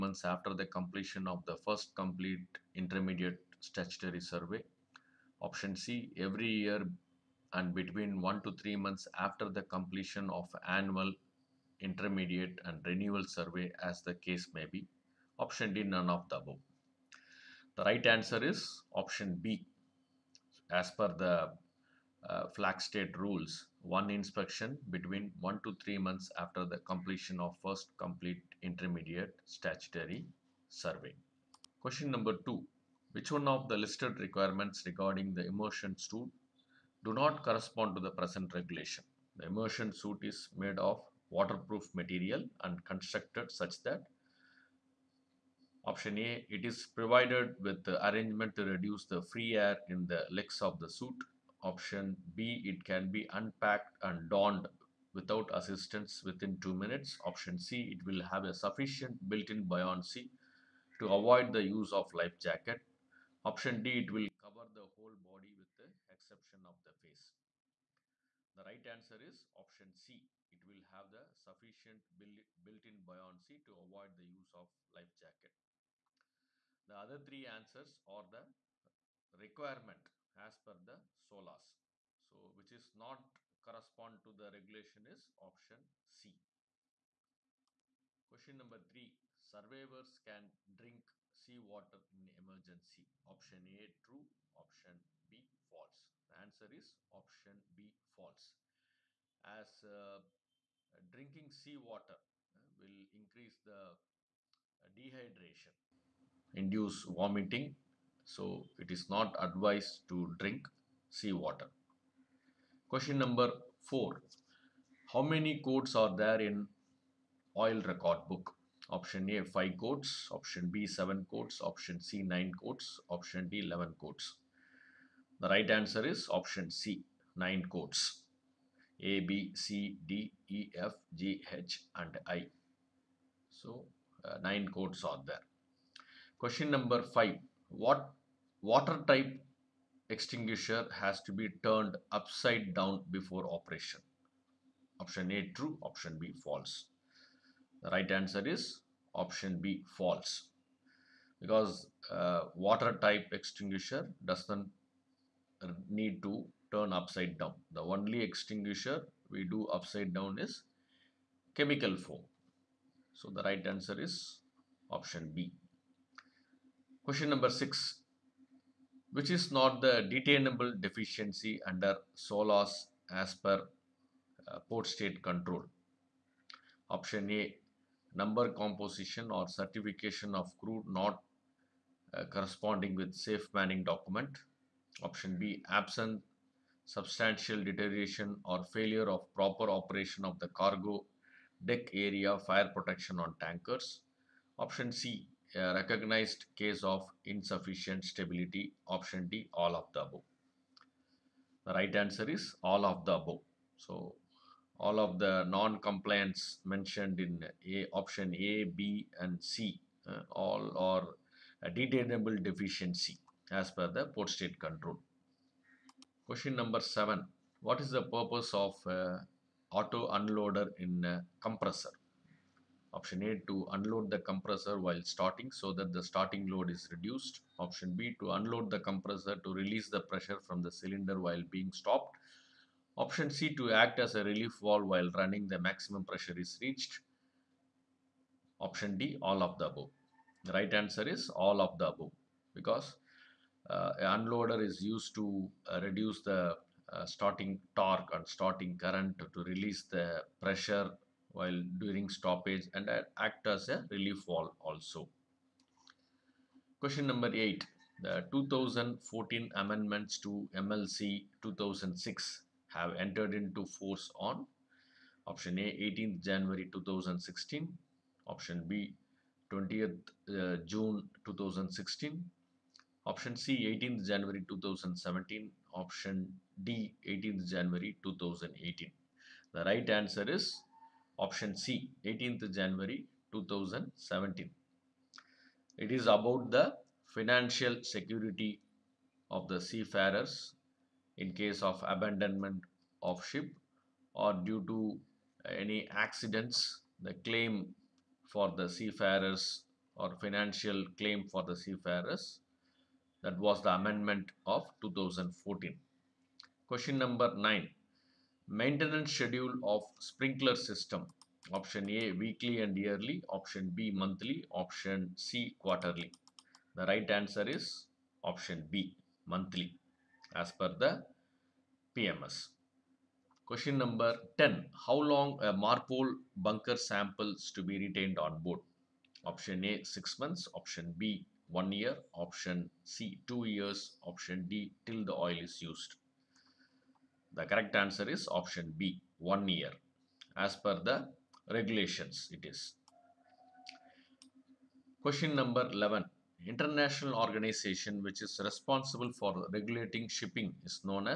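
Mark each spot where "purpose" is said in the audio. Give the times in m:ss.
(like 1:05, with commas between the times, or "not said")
3:38.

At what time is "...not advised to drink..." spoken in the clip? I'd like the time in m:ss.
1:49.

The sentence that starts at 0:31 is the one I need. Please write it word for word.
Question number two, which one of the listed requirements regarding the immersion suit do not correspond to the present regulation?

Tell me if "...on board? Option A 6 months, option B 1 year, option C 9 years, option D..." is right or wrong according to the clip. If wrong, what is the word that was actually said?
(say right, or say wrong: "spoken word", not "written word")
wrong: "2", not "9".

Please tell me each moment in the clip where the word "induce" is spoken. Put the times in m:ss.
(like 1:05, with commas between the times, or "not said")
1:46.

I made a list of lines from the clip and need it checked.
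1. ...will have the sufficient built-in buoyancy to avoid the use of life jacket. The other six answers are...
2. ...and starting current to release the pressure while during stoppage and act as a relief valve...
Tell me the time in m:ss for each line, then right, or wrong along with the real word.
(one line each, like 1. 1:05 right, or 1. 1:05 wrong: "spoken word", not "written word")
1. 1:10 wrong: "three", not "six"
2. 4:08 right.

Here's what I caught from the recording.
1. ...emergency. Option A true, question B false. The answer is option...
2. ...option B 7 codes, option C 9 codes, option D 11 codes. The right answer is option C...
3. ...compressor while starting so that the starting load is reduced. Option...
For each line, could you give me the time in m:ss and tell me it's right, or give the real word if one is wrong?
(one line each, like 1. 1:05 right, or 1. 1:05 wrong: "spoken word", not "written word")
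1. 1:32 wrong: "option", not "question"
2. 2:00 right
3. 3:44 right.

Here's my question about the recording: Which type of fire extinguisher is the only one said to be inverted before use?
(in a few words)
Chemical foam.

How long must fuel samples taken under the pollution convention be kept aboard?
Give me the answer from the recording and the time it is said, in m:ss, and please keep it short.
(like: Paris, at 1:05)
1 year, at 5:39.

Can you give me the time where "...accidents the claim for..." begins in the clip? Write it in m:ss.
4:55.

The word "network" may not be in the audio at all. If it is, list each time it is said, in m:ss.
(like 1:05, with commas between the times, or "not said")
not said.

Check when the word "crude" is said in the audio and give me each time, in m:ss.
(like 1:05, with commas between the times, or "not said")
3:00.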